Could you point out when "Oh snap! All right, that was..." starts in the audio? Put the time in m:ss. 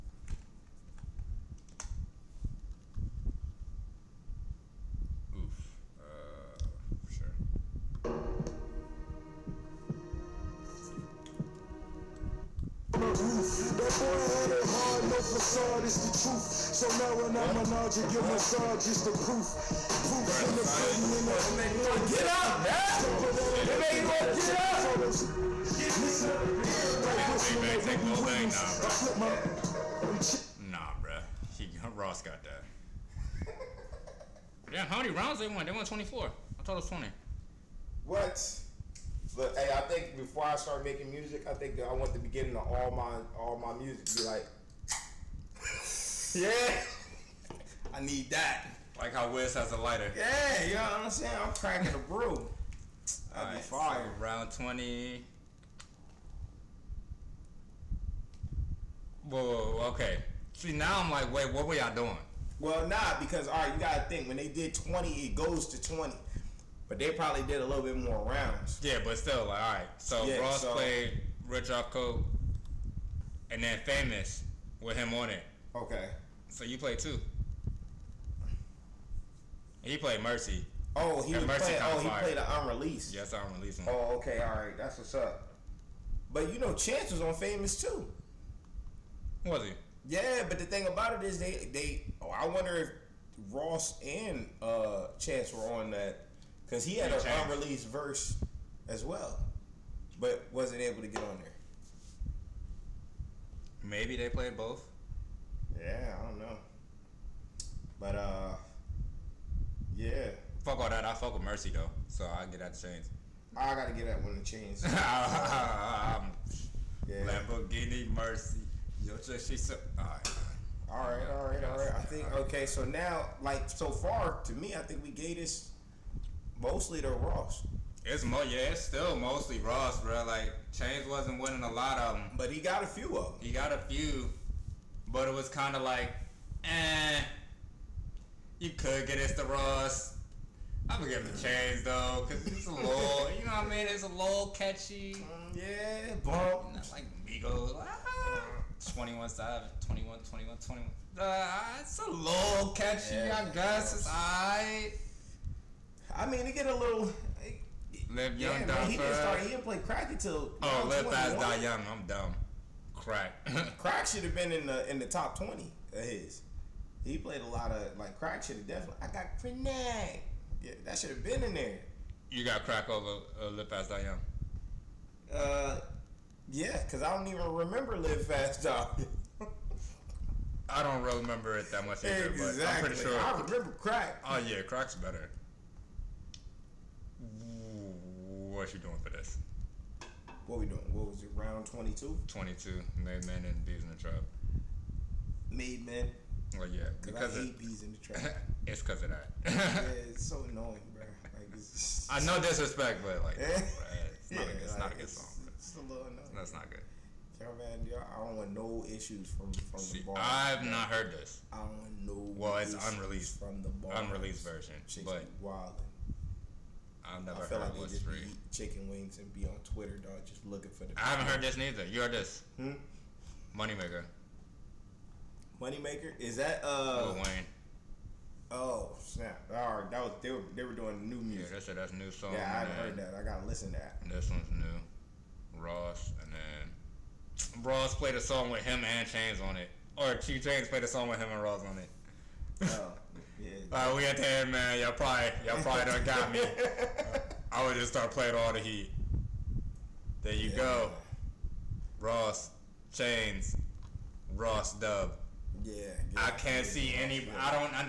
3:48.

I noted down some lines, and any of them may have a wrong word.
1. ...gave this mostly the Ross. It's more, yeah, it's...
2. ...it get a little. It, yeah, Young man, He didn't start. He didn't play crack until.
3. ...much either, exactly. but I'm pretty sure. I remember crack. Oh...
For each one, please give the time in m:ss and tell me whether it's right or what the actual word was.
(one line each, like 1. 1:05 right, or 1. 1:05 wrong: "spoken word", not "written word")
1. 2:05 right
2. 2:36 right
3. 3:01 right.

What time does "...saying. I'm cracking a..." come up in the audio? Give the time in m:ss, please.
0:51.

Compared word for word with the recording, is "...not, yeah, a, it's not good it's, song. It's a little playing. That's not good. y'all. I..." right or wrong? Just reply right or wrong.
wrong.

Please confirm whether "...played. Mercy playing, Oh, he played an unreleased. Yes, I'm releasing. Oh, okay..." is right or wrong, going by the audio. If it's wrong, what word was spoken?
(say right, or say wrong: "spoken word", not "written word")
right.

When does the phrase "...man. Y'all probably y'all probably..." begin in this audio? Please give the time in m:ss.
4:04.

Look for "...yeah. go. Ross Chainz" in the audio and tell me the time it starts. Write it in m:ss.
4:10.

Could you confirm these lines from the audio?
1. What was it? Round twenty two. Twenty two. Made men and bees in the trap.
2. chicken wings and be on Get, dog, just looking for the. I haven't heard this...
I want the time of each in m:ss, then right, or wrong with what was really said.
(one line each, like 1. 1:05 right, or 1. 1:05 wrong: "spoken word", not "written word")
1. 3:10 right
2. 3:38 wrong: "Twitter", not "Get".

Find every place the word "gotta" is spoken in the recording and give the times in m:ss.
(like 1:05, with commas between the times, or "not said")
1:03, 1:53, 3:53.